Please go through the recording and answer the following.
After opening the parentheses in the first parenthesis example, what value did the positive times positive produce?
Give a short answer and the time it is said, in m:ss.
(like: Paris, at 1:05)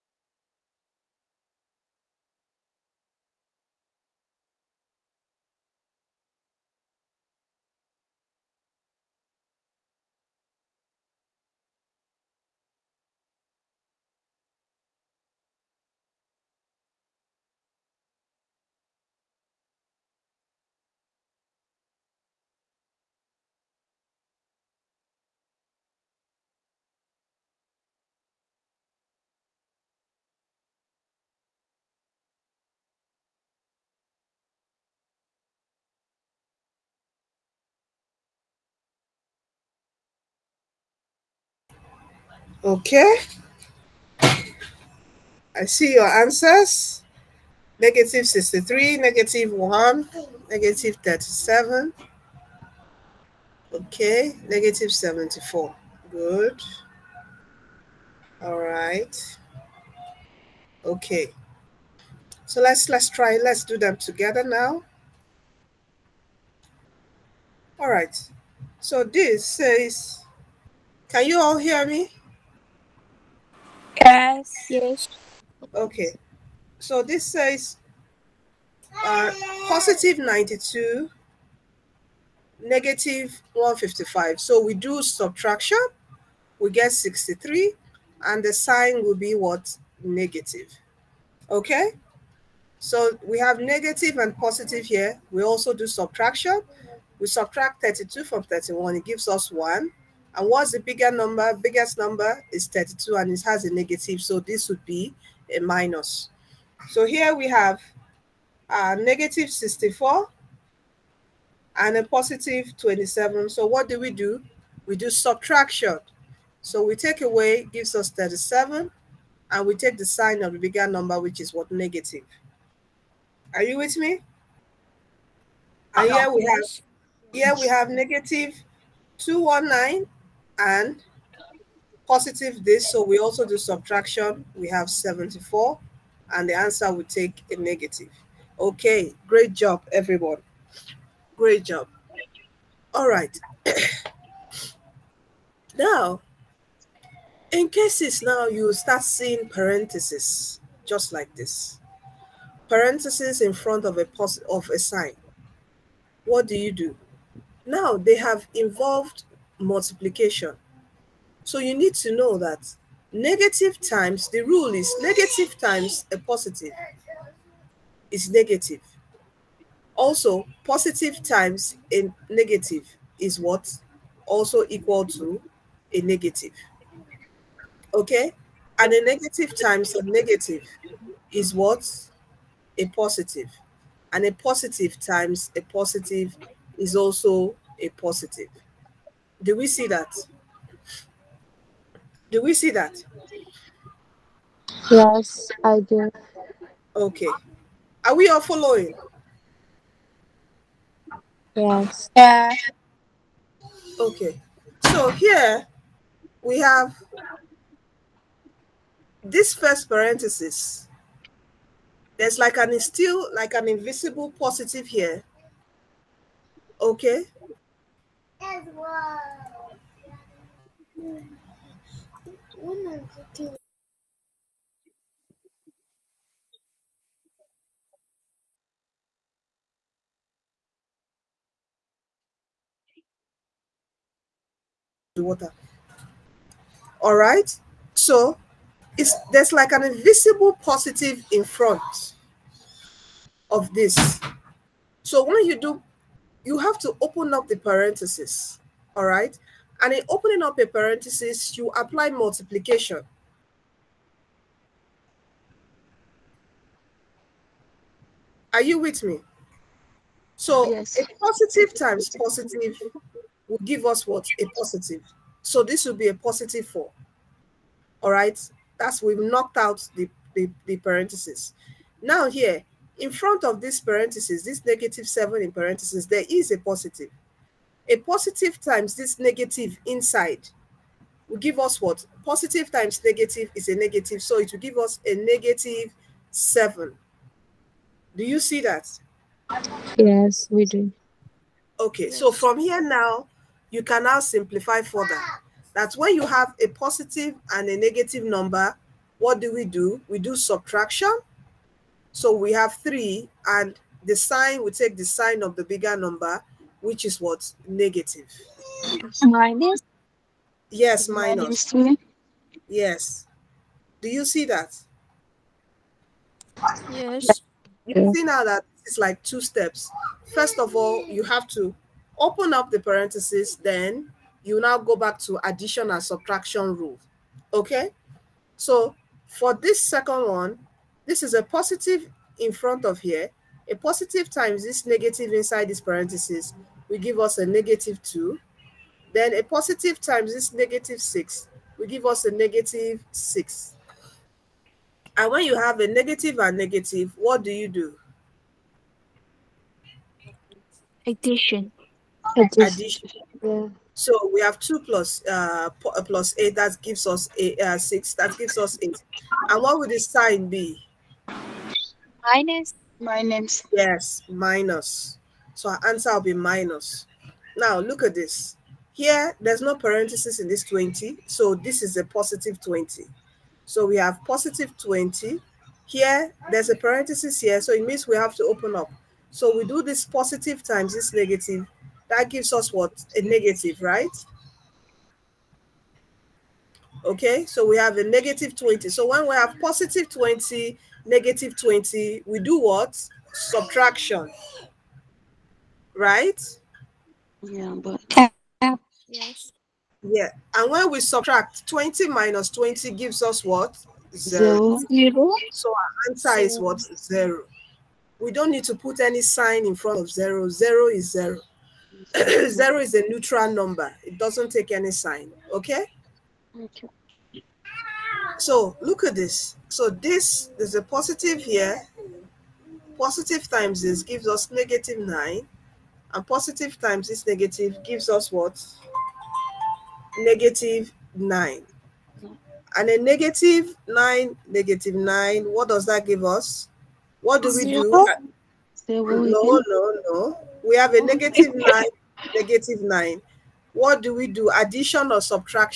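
positive 4, at 4:26.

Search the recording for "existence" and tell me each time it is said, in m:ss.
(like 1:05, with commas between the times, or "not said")
not said.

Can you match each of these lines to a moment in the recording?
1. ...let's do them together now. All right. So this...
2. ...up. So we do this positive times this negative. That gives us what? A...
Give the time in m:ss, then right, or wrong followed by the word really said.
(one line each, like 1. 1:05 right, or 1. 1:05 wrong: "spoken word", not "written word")
1. 1:03 right
2. 6:18 right.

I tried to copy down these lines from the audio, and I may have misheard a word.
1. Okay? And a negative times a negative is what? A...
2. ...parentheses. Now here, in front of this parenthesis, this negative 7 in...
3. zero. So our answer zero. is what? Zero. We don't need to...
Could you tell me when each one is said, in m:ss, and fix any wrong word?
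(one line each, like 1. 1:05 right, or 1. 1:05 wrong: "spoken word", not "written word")
1. 2:57 right
2. 4:30 right
3. 6:44 right.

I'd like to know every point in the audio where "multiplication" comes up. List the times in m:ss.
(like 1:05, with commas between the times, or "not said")
2:39, 4:12.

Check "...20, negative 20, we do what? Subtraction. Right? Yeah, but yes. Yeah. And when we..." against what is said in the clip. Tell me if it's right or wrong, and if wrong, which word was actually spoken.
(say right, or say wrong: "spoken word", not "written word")
right.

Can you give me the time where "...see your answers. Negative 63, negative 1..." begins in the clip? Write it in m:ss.
0:45.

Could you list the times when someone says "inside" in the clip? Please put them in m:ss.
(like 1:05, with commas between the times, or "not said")
4:39, 5:35.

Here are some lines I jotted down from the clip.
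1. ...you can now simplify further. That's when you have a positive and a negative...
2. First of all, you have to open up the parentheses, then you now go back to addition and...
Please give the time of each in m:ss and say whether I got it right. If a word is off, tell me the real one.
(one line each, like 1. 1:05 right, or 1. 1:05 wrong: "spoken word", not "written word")
1. 4:53 right
2. 5:20 right.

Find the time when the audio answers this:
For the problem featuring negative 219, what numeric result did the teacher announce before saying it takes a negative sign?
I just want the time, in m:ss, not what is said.
2:14.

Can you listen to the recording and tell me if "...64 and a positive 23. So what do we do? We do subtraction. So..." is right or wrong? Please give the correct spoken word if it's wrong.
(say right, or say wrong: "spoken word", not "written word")
wrong: "27", not "23".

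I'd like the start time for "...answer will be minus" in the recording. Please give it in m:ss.
6:05.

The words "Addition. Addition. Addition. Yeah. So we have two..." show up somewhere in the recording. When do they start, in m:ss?
5:51.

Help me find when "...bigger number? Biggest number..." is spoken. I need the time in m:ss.
1:40.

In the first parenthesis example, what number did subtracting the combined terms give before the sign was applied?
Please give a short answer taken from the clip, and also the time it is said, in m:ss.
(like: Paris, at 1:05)
3, at 5:02.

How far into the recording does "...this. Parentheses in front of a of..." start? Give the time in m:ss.
2:31.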